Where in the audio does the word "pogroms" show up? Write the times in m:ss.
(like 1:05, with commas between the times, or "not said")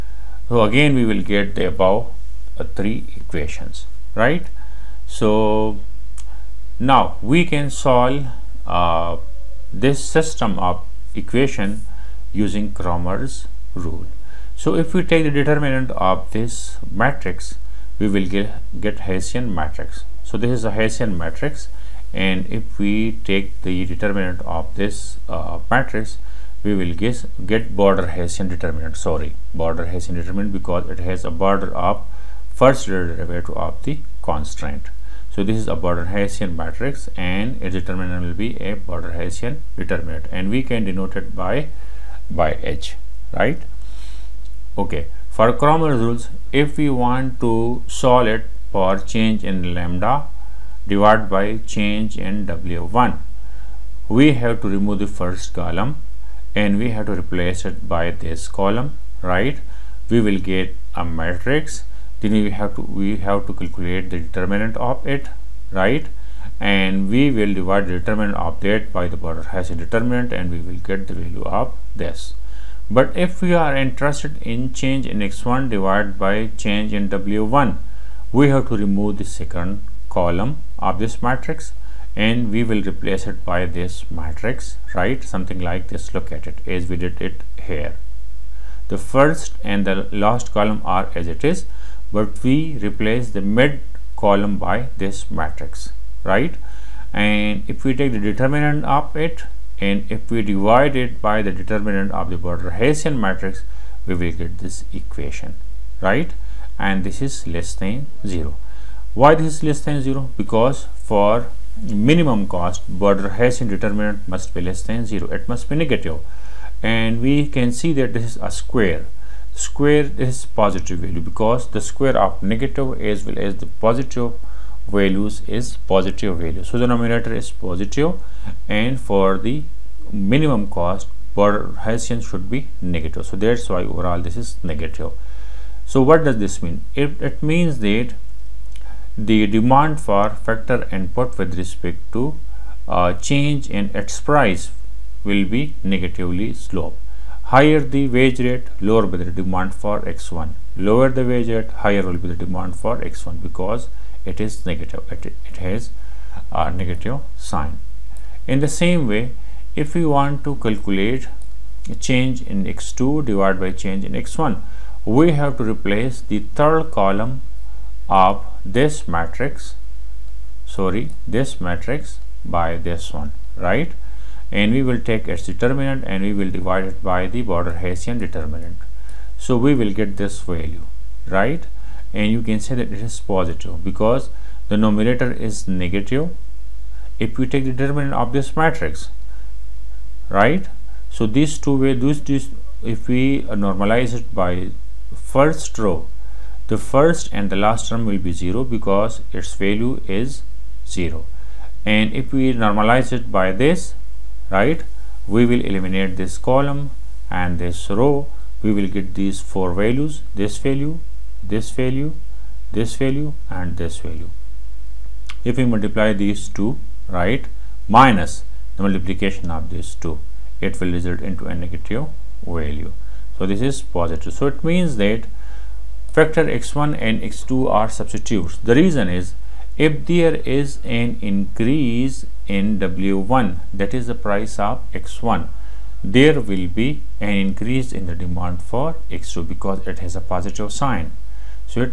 not said.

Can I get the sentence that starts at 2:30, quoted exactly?
Lower the wage rate, higher will be the demand for X1 because it is negative.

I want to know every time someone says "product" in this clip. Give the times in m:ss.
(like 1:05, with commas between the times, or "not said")
1:09.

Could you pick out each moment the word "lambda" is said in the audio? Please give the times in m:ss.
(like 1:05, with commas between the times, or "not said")
0:49.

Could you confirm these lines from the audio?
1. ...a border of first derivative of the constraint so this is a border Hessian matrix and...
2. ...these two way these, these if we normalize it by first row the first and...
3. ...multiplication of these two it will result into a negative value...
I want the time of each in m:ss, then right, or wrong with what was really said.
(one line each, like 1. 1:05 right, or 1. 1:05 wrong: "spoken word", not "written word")
1. 0:31 right
2. 3:11 right
3. 3:38 right.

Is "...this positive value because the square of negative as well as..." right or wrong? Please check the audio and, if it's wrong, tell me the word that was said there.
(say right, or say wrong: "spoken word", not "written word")
right.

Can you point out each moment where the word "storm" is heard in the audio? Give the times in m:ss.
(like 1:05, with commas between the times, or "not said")
not said.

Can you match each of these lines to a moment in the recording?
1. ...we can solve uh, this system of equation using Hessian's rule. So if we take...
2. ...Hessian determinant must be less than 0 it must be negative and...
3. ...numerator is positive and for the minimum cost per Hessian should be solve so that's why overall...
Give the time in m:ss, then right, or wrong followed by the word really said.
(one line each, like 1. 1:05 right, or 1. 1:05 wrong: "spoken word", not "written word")
1. 0:07 wrong: "Cramer", not "Hessian"
2. 1:53 right
3. 2:06 wrong: "negative", not "solve".